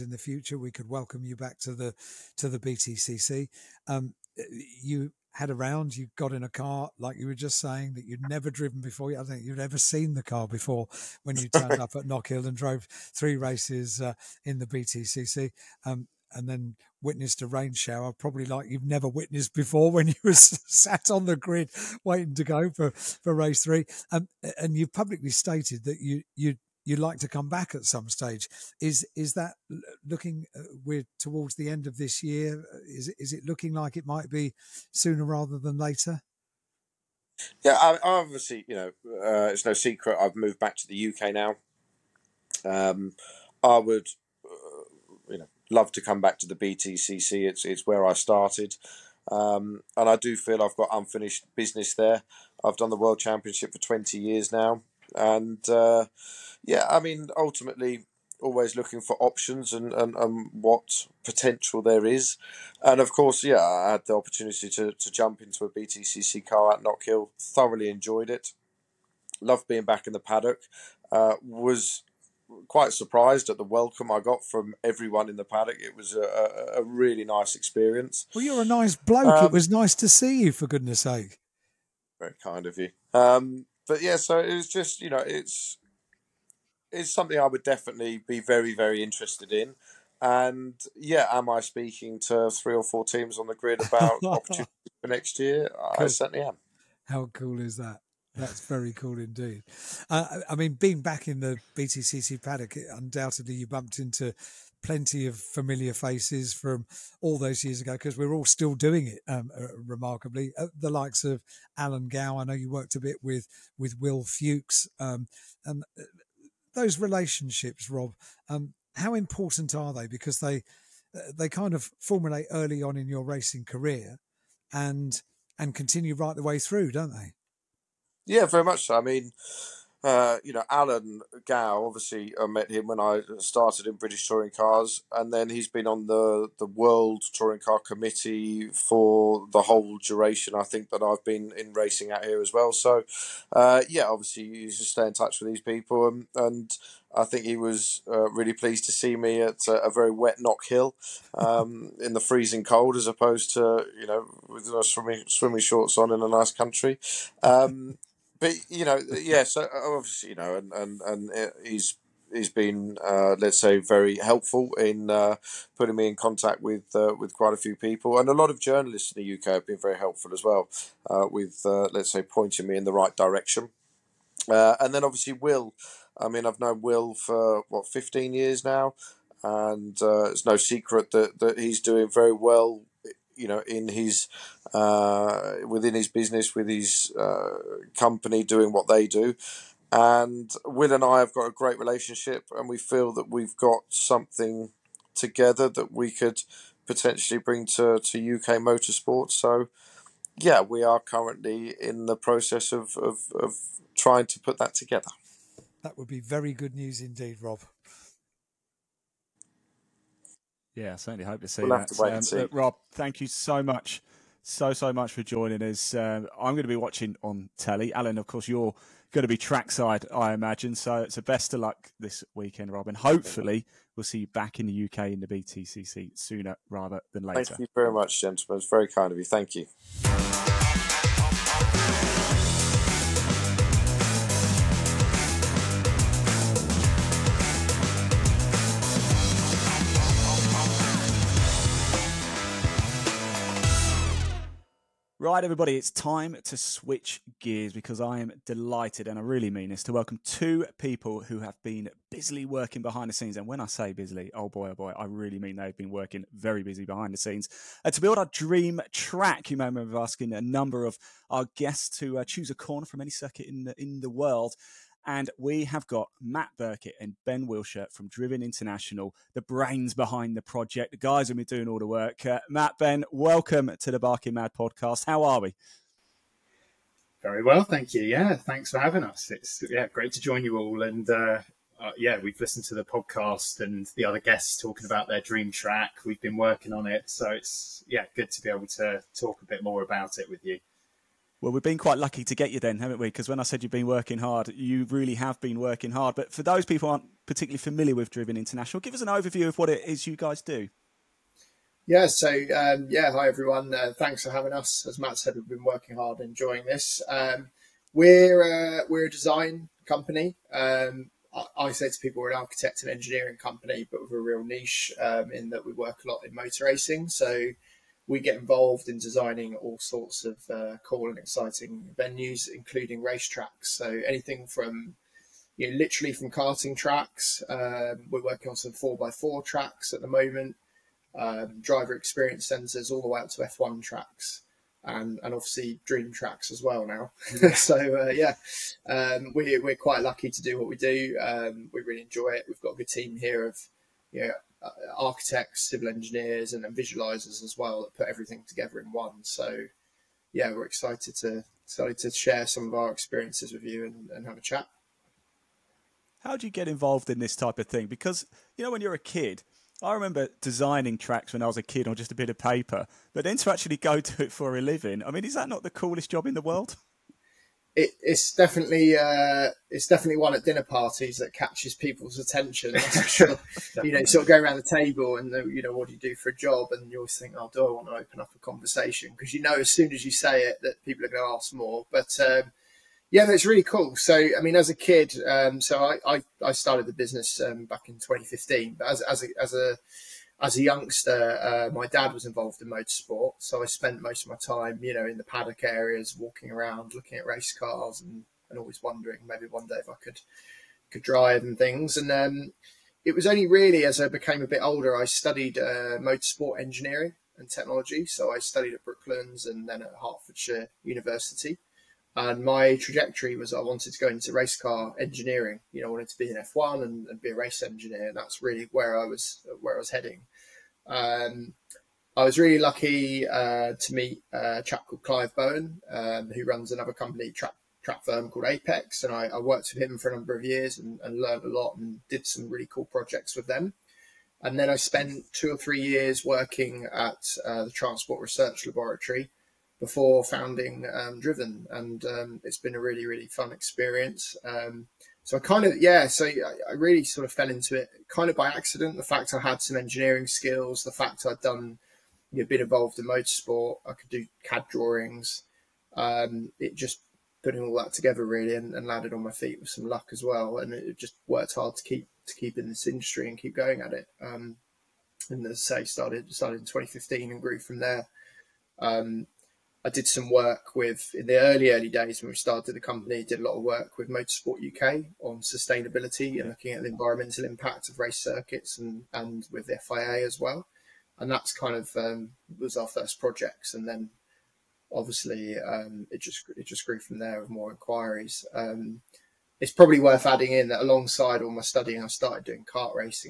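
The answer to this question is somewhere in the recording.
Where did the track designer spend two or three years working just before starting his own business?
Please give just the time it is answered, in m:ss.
7:17.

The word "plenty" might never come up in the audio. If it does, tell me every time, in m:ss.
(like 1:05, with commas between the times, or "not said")
1:44.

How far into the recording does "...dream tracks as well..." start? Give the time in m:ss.
5:35.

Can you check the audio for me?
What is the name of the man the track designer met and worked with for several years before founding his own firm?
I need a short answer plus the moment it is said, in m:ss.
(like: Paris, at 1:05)
Clive Bowen, at 7:05.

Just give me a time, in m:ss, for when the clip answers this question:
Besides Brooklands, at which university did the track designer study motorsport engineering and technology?
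6:50.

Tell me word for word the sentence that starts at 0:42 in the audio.
Um, I would, uh, you know, love to come back to the BTCC.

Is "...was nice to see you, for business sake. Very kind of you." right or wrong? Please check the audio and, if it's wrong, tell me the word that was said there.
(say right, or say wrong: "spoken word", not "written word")
wrong: "goodness", not "business".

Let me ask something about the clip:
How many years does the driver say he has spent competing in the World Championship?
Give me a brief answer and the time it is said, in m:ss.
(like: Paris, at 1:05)
20, at 0:53.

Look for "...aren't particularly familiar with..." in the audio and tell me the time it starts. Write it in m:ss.
4:56.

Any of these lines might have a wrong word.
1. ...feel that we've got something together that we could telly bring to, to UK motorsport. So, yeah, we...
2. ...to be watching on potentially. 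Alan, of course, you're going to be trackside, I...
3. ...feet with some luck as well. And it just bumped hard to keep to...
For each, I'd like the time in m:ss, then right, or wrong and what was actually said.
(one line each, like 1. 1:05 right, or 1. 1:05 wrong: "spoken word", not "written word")
1. 3:12 wrong: "potentially", not "telly"
2. 3:36 wrong: "telly", not "potentially"
3. 7:39 wrong: "worked", not "bumped".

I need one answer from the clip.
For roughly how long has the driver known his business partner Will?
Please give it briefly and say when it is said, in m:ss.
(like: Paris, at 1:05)
15 years, at 2:57.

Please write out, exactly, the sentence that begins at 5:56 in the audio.
How do you get involved in this type of thing?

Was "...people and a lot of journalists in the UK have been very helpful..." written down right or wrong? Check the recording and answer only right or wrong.
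right.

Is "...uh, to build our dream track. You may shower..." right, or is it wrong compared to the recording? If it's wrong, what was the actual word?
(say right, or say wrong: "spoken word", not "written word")
wrong: "remember", not "shower".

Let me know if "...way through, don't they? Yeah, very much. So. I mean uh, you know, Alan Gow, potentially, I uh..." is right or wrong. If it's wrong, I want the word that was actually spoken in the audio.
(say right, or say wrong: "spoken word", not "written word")
wrong: "obviously", not "potentially".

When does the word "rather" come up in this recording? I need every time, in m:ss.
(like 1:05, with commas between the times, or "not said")
0:35, 3:46.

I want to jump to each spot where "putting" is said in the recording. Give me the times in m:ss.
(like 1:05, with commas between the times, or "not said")
2:45, 7:37.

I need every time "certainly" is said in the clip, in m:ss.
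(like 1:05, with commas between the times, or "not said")
1:36, 3:30.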